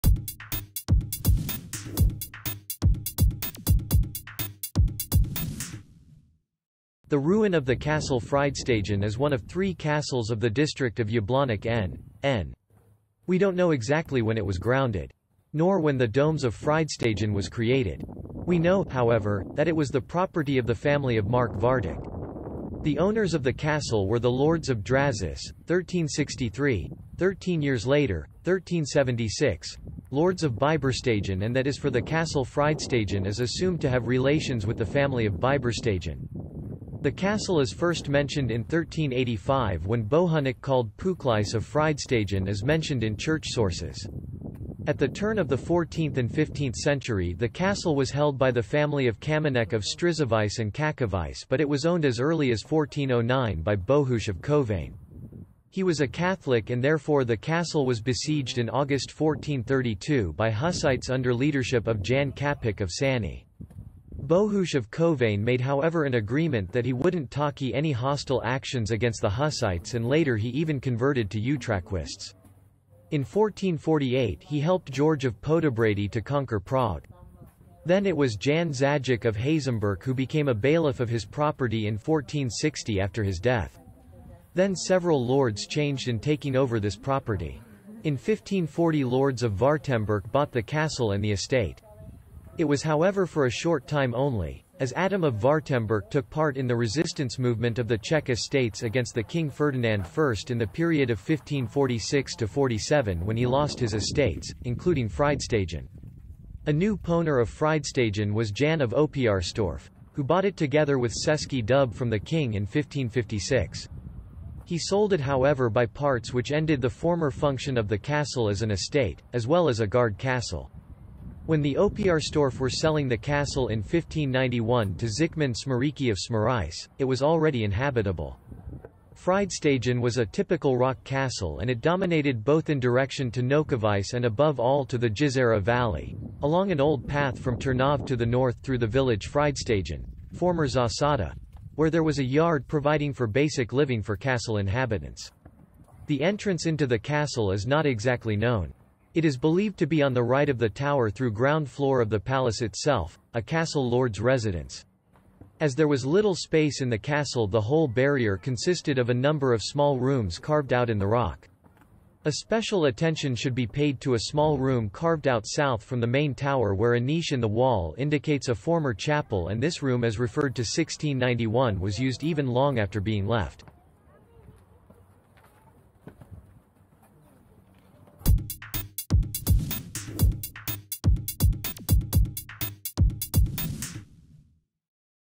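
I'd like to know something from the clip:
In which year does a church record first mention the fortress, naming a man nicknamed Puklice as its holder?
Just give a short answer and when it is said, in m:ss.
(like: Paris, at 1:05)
1385, at 0:38.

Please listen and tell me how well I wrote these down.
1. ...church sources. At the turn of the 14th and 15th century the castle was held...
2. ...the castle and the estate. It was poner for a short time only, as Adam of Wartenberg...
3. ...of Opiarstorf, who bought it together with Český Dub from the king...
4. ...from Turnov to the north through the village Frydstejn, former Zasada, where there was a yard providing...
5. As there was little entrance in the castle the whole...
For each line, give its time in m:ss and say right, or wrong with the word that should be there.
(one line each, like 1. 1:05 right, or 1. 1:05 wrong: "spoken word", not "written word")
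1. 0:43 right
2. 1:30 wrong: "however", not "poner"
3. 1:48 right
4. 2:17 right
5. 2:35 wrong: "space", not "entrance".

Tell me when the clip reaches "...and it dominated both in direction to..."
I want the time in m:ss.
2:11.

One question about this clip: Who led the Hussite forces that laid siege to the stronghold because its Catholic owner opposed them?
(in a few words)
Jan Kapik of Sani.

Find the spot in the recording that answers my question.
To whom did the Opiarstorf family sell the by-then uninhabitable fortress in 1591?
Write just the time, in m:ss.
2:05.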